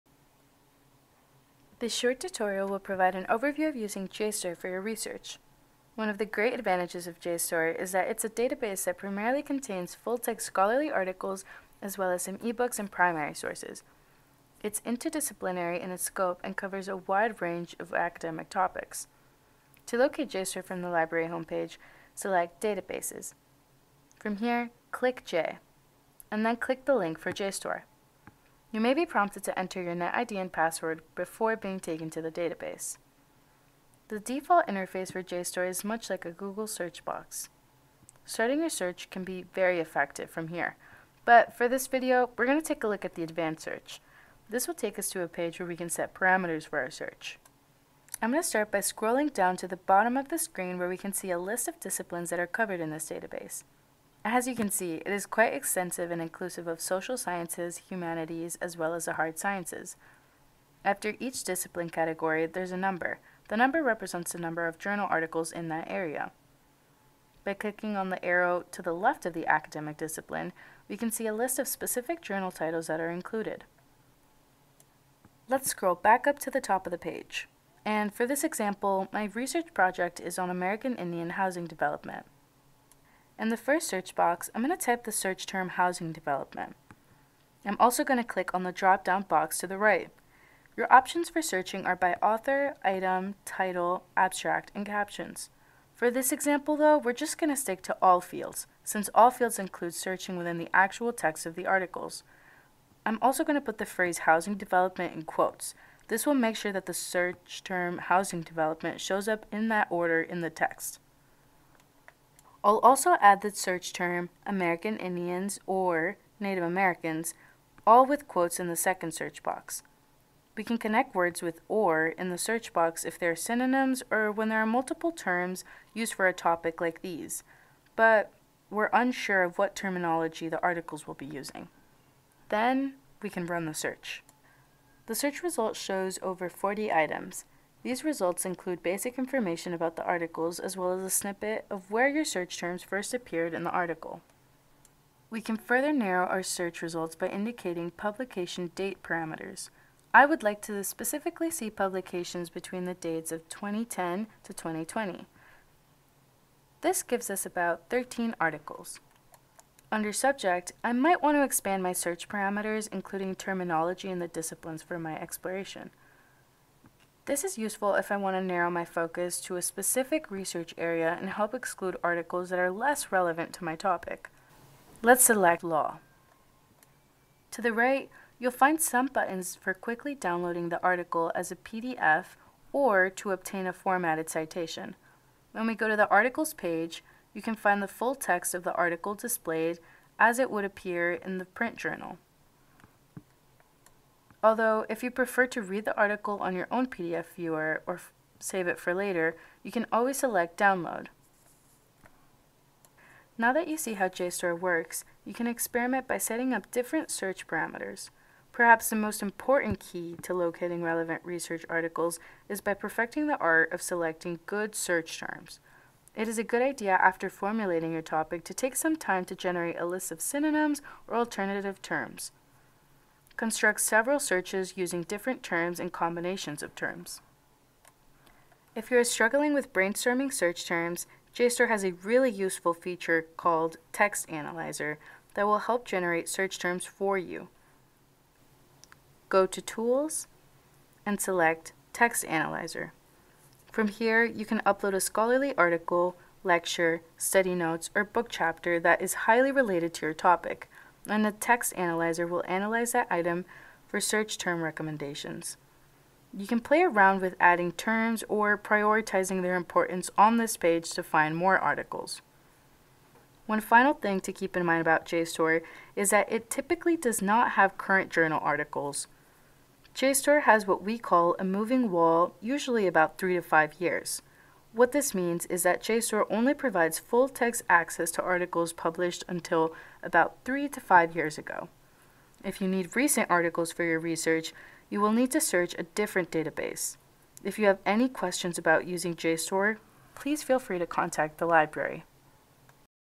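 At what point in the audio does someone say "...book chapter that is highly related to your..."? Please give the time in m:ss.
4:08.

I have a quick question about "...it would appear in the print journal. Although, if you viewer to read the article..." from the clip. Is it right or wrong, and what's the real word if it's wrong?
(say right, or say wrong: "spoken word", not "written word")
wrong: "prefer", not "viewer".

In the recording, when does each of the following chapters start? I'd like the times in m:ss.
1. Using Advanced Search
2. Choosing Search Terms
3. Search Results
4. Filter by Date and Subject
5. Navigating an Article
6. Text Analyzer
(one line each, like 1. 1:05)
1. 0:30
2. 1:20
3. 2:18
4. 2:30
5. 3:08
6. 3:58.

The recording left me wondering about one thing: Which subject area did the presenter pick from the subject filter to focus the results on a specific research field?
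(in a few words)
Law.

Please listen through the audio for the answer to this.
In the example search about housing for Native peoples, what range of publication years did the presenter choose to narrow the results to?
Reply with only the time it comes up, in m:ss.
2:33.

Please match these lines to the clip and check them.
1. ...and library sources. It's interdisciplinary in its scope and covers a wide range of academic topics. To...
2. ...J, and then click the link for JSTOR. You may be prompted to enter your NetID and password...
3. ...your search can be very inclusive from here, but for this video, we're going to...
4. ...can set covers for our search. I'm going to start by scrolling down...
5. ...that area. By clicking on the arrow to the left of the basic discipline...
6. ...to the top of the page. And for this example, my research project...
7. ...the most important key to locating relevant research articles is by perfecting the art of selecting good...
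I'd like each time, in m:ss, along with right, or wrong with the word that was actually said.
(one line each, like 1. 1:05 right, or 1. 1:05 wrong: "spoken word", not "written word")
1. 0:12 wrong: "primary", not "library"
2. 0:25 right
3. 0:38 wrong: "effective", not "inclusive"
4. 0:45 wrong: "parameters", not "covers"
5. 1:05 wrong: "academic", not "basic"
6. 1:16 right
7. 3:28 right.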